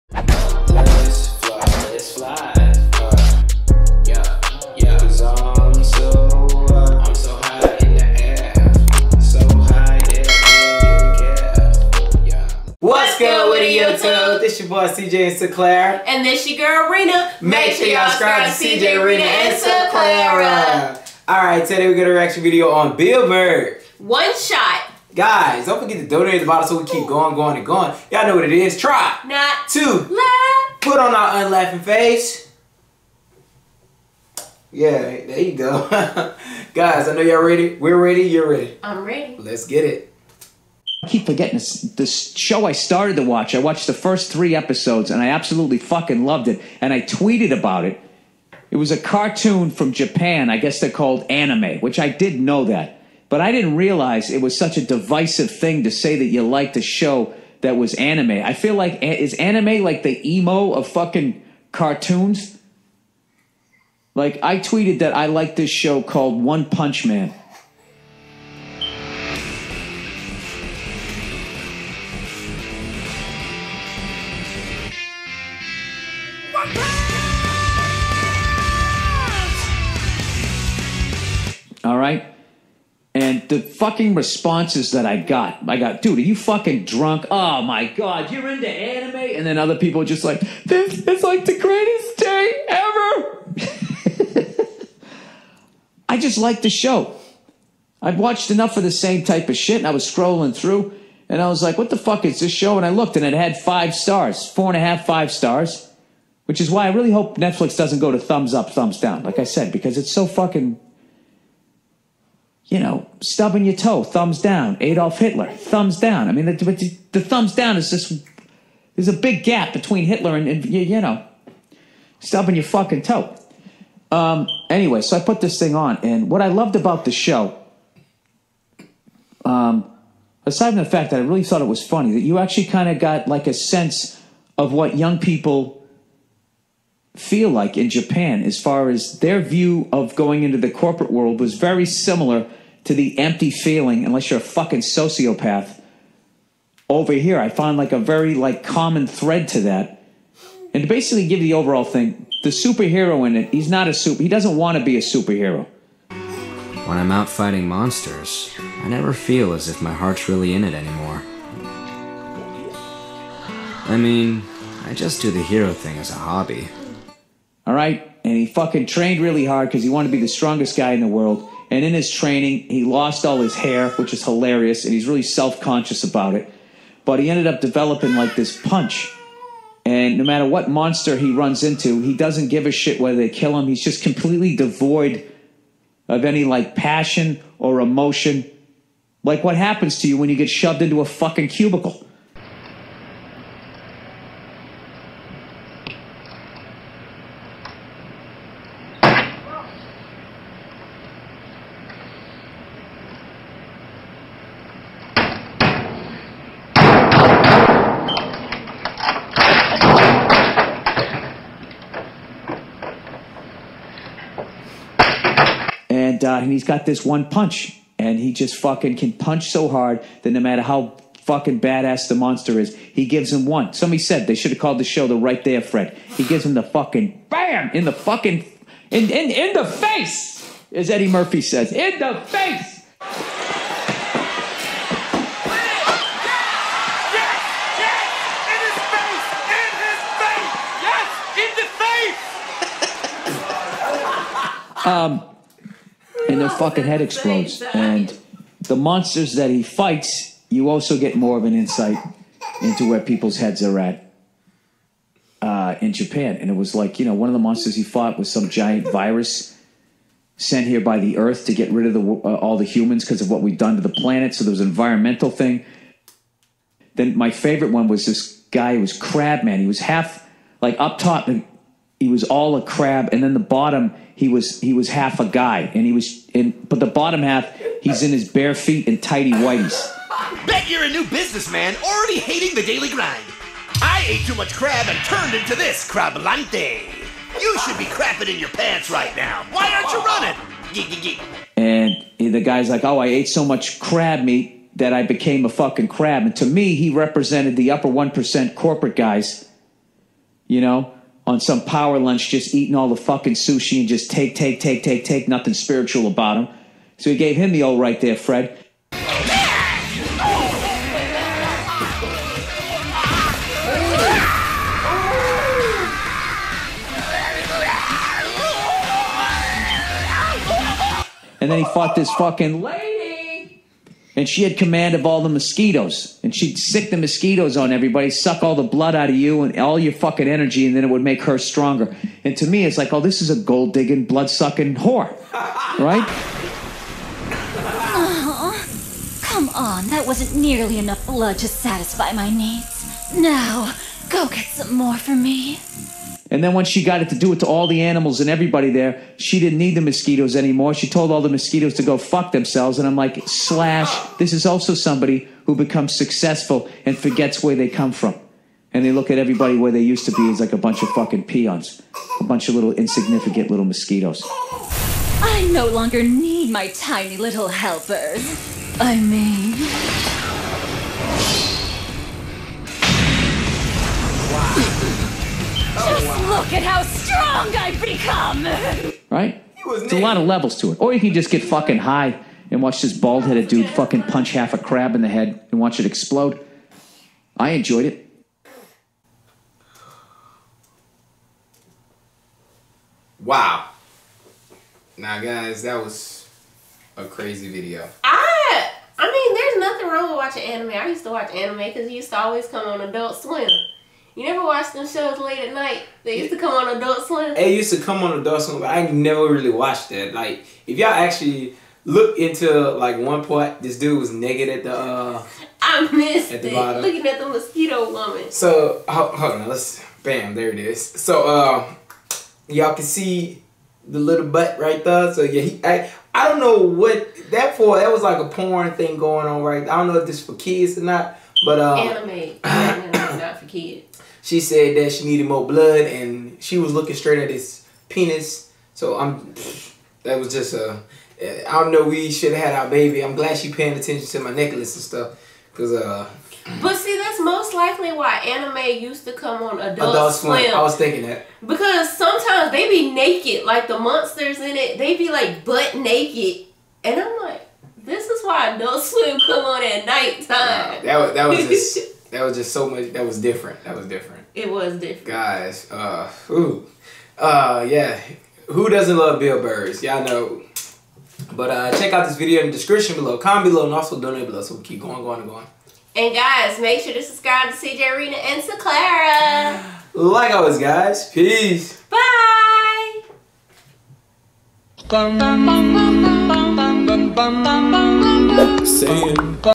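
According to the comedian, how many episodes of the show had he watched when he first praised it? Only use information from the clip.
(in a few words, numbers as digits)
3.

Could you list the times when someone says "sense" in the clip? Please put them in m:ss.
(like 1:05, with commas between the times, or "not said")
2:13.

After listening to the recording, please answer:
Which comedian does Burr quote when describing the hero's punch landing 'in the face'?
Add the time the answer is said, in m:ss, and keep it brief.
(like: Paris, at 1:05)
Eddie Murphy, at 3:50.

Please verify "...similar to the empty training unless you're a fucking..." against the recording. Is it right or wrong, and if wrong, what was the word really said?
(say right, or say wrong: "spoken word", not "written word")
wrong: "feeling", not "training".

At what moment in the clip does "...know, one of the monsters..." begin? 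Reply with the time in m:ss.
4:17.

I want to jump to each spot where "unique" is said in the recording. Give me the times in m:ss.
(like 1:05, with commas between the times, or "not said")
not said.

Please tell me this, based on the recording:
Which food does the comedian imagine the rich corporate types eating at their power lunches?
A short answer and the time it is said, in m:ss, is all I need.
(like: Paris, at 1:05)
sushi, at 5:03.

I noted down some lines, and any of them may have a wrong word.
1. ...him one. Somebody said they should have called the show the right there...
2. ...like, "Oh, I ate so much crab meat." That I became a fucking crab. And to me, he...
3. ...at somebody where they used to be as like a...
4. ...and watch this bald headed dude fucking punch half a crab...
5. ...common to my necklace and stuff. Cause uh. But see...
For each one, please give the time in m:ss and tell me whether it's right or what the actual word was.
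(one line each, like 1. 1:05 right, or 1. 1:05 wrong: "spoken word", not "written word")
1. 3:43 right
2. 4:52 right
3. 5:59 wrong: "everybody", not "somebody"
4. 6:22 right
5. 7:23 wrong: "attention", not "common".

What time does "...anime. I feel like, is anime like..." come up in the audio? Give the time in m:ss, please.
0:57.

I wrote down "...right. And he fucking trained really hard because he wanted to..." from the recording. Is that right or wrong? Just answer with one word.
right.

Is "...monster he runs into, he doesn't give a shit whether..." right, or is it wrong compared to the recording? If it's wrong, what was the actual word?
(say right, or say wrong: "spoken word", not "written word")
right.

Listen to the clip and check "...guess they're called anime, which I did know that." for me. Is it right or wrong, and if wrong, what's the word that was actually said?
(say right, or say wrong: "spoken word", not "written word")
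right.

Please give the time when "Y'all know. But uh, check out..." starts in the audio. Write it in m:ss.
7:49.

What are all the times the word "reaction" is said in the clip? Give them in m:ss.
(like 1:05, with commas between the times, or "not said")
0:22.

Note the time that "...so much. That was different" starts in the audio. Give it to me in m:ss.
7:42.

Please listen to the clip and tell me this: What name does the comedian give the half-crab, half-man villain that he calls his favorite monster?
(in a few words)
Crabman.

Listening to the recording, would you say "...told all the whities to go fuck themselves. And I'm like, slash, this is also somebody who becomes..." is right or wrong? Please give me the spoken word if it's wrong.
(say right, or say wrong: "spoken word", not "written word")
wrong: "mosquitoes", not "whities".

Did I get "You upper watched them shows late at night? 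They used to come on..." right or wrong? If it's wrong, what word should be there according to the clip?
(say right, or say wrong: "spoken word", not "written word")
wrong: "never", not "upper".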